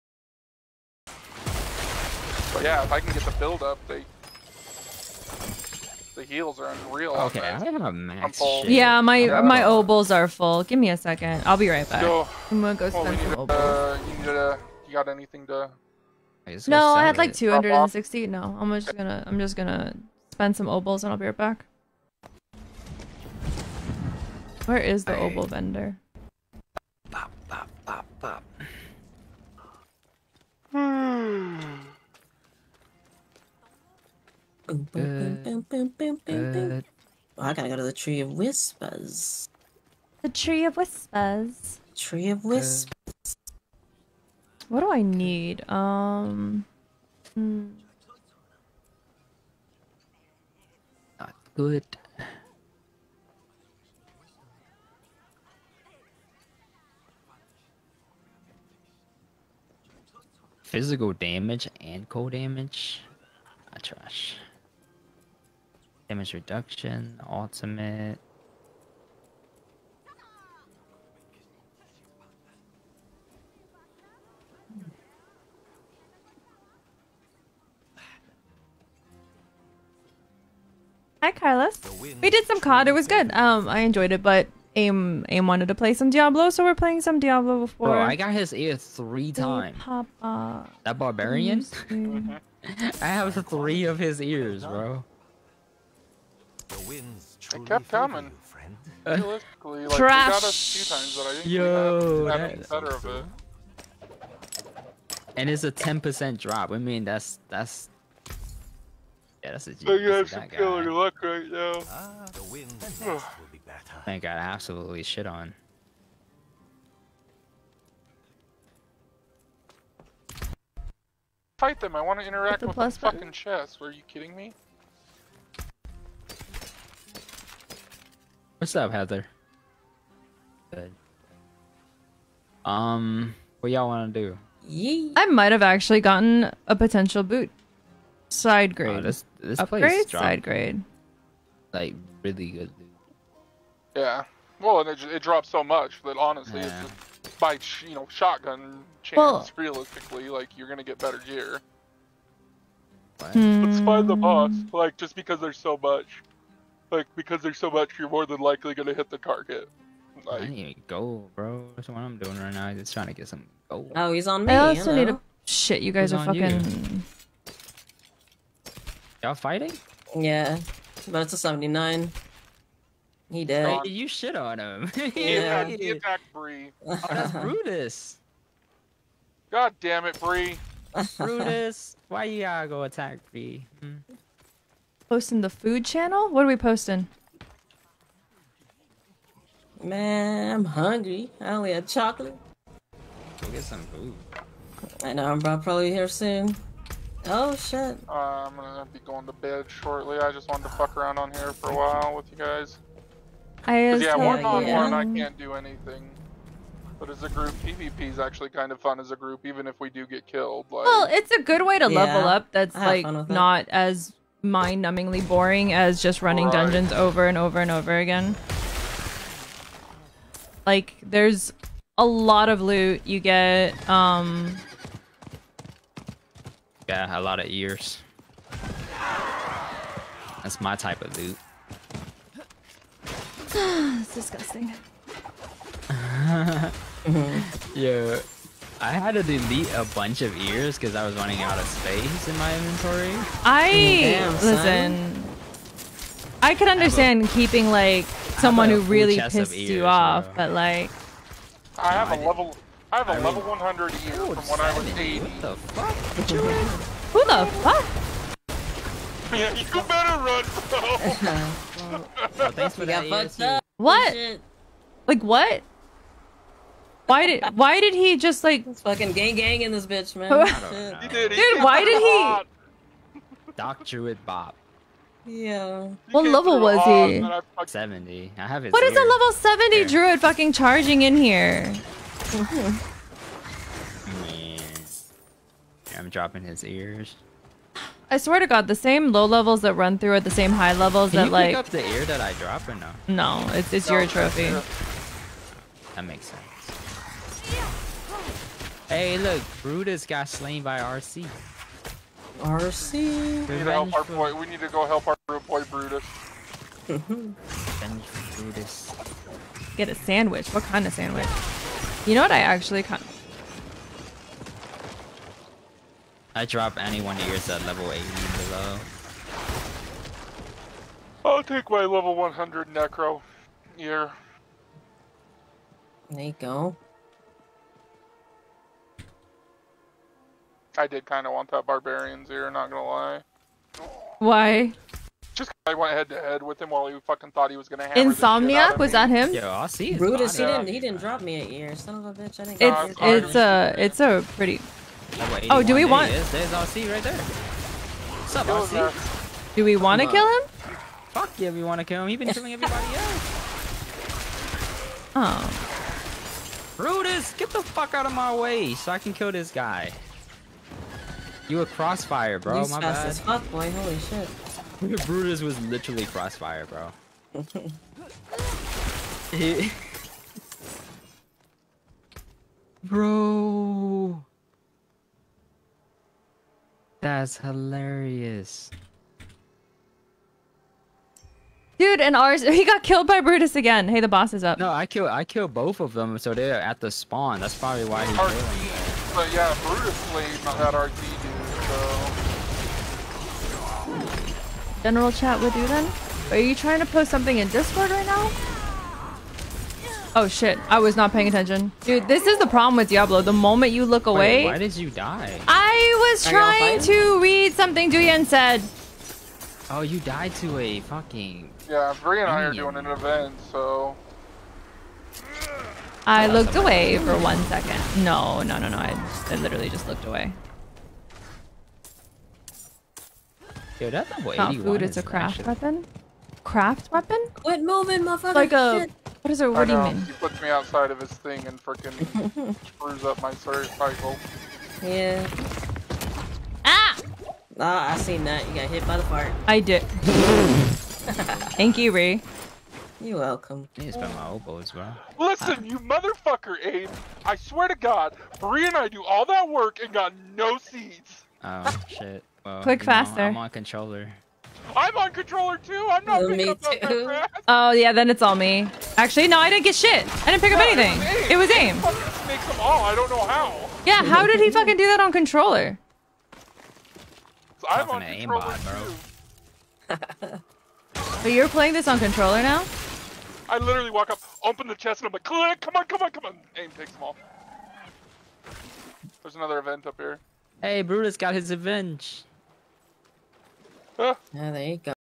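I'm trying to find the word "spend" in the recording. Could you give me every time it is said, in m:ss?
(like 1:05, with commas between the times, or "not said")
0:12, 0:20.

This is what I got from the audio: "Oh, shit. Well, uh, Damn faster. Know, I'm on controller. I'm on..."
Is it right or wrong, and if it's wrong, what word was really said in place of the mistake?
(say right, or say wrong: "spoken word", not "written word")
wrong: "Click", not "Damn".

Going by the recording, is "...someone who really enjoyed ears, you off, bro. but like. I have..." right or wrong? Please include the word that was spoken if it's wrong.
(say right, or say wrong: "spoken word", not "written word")
wrong: "pissed", not "enjoyed".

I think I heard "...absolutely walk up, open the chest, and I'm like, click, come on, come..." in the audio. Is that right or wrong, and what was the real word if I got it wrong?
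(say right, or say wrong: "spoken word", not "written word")
wrong: "literally", not "absolutely".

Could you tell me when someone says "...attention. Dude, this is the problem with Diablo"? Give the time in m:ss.
6:41.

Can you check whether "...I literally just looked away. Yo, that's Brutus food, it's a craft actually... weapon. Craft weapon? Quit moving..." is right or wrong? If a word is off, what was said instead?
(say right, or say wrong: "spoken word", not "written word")
wrong: "Not", not "Brutus".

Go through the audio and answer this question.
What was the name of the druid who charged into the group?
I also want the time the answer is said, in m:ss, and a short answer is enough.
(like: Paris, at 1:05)
Doc Druid Bob, at 4:33.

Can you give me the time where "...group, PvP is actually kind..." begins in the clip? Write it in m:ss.
3:27.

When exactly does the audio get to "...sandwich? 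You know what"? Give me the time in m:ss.
5:10.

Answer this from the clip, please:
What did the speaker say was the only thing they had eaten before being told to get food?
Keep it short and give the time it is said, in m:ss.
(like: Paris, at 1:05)
chocolate, at 3:11.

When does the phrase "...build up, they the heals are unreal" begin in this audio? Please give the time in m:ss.
0:03.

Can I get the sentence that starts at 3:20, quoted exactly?
I just wanted to fuck around on here for a while with you guys.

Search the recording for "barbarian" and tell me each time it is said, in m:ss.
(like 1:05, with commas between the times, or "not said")
1:30, 5:31.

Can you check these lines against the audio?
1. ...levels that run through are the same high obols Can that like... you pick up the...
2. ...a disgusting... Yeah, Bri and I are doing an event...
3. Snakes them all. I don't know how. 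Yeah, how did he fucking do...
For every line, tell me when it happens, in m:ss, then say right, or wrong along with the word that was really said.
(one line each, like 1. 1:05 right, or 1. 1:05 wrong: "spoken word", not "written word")
1. 4:49 wrong: "levels", not "obols"
2. 6:50 wrong: "fucking", not "disgusting"
3. 7:42 right.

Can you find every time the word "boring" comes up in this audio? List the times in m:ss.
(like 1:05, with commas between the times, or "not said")
3:35.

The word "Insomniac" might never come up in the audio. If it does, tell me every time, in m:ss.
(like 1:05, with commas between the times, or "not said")
5:37.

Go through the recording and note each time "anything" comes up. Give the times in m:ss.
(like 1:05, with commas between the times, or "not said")
0:15, 3:25, 7:40.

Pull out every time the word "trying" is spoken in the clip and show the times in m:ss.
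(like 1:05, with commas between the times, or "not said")
2:42, 6:36, 6:46.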